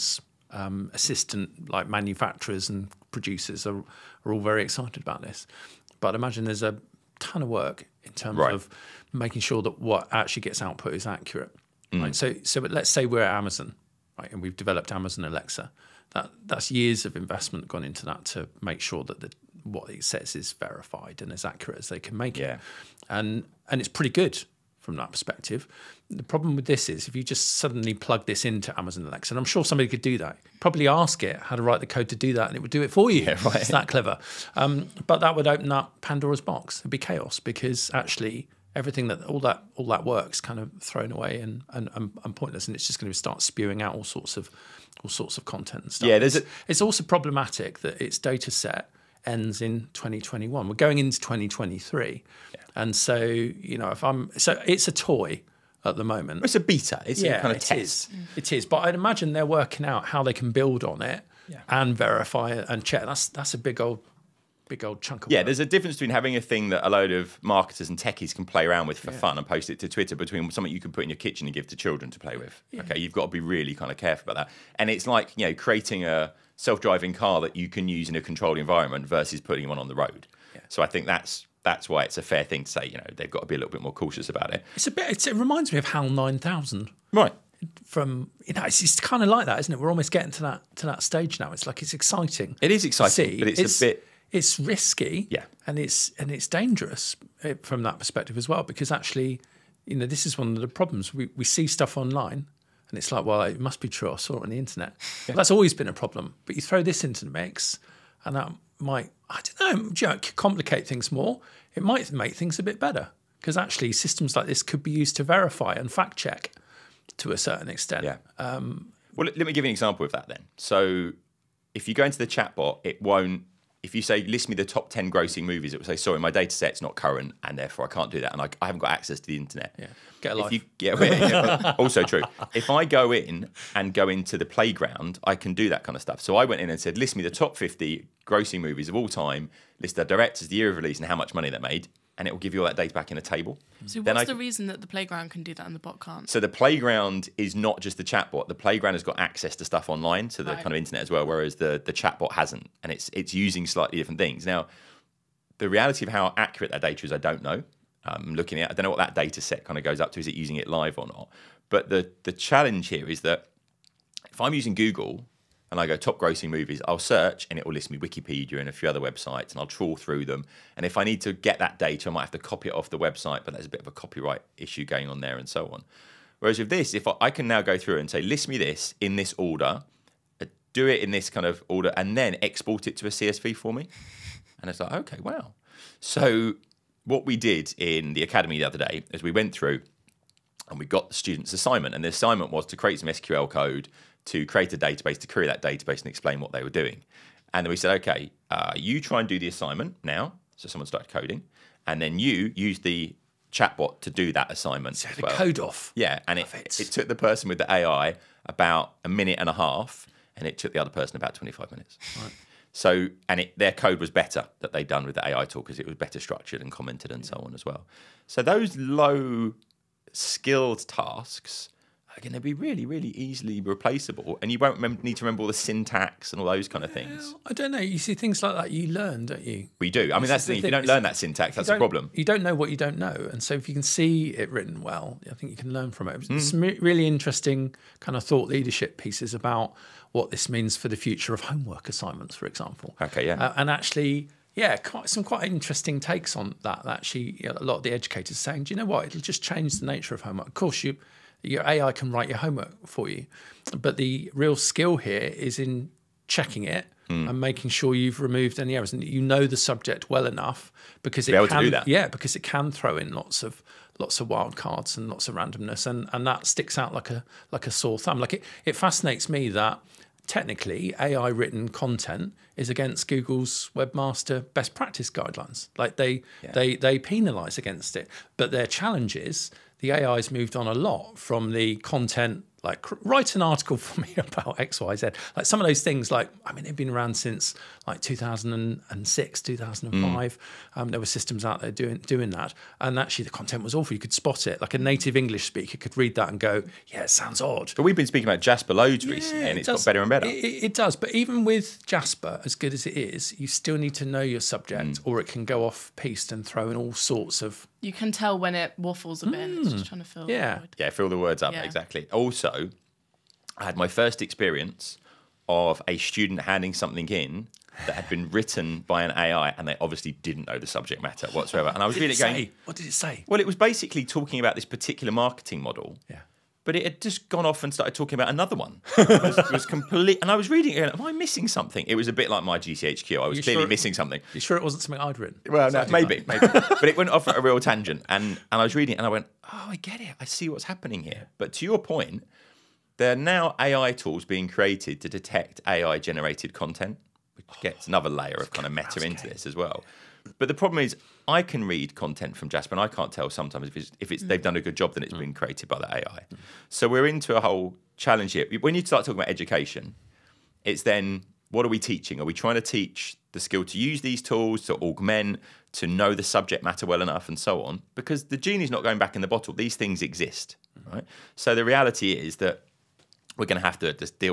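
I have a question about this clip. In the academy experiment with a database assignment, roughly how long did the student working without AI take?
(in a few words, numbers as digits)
25 minutes.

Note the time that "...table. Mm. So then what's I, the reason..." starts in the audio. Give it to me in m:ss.
2:23.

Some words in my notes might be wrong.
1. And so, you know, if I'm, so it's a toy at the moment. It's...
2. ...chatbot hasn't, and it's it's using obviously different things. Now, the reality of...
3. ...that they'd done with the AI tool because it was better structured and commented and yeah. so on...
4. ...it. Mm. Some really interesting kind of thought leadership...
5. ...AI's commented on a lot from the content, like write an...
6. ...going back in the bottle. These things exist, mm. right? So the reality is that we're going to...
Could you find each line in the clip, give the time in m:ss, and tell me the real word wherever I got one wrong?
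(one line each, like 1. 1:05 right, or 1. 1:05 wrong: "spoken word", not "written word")
1. 0:52 right
2. 2:31 wrong: "slightly", not "obviously"
3. 3:34 right
4. 3:56 right
5. 4:40 wrong: "moved", not "commented"
6. 6:08 right.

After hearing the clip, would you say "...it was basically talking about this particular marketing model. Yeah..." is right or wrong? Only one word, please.
right.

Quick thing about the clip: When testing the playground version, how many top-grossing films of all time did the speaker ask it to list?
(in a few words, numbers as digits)
50.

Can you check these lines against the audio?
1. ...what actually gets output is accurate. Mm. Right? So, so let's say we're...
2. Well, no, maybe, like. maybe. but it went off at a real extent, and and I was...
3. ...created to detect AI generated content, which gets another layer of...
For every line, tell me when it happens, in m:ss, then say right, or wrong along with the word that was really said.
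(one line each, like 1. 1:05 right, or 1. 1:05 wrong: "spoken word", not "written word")
1. 0:09 right
2. 5:35 wrong: "tangent", not "extent"
3. 5:44 right.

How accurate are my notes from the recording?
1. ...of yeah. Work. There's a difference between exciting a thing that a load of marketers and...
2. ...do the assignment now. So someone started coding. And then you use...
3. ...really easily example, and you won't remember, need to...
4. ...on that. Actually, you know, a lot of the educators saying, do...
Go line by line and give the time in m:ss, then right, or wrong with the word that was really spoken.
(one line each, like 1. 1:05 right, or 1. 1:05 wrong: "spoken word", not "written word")
1. 1:05 wrong: "having", not "exciting"
2. 3:19 right
3. 3:42 wrong: "replaceable", not "example"
4. 4:06 right.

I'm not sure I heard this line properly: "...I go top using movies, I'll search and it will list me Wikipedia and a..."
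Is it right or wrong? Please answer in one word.
wrong.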